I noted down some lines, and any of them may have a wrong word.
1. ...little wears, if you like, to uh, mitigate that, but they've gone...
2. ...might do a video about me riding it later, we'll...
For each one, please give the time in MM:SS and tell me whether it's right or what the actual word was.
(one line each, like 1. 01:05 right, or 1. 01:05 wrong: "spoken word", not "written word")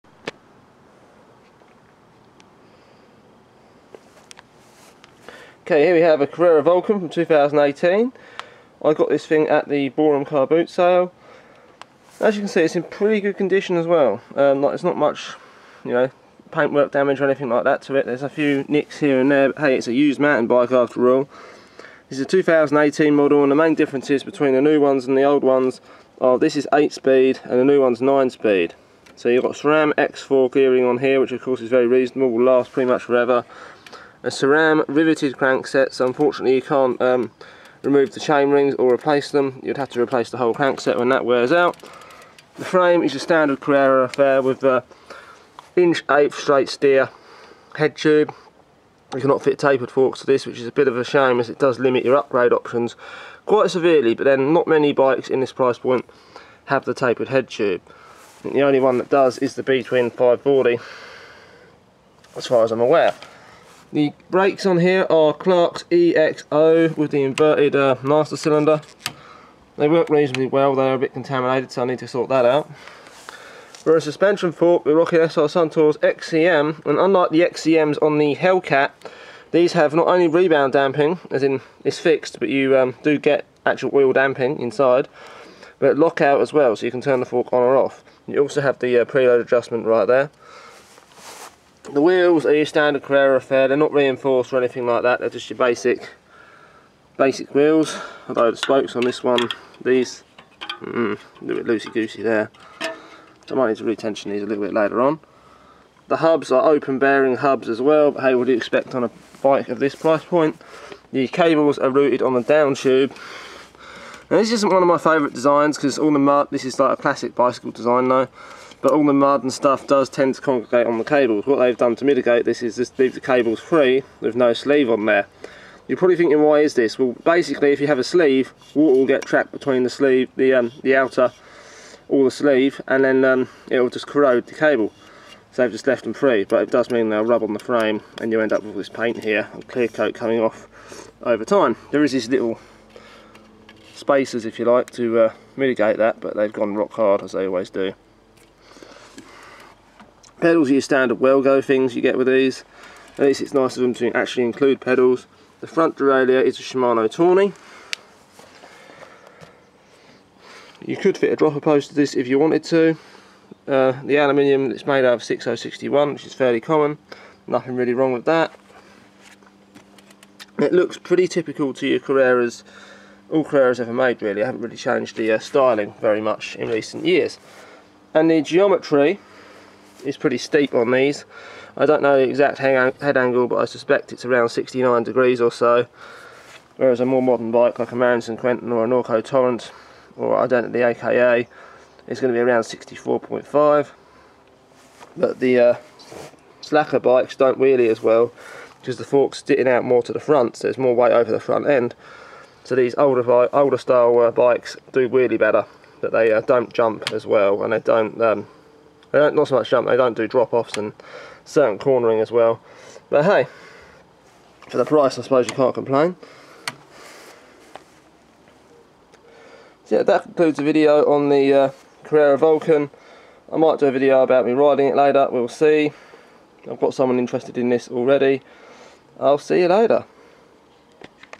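1. 02:22 wrong: "spacers", not "wears"
2. 03:43 right.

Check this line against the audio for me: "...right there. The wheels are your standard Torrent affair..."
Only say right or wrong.
wrong.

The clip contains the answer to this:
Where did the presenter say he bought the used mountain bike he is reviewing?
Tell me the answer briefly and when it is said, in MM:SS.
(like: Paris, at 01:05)
Borum car boot sale, at 00:09.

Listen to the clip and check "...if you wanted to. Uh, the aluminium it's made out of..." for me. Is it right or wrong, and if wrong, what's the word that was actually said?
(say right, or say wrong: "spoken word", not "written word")
right.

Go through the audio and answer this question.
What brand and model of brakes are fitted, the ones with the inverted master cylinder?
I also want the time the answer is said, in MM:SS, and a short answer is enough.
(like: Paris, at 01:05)
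Clark's EXO, at 01:05.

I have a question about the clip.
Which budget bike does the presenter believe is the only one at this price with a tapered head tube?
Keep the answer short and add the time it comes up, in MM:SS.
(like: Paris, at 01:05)
B-twin 540, at 00:59.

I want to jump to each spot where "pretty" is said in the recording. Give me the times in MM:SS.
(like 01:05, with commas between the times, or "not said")
00:12, 00:32, 02:50, 03:00.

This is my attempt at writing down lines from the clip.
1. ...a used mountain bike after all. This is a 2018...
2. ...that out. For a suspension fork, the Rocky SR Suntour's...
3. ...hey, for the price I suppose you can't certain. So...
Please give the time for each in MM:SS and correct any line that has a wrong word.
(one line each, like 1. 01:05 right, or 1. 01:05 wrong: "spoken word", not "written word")
1. 00:19 right
2. 01:12 right
3. 03:33 wrong: "complain", not "certain".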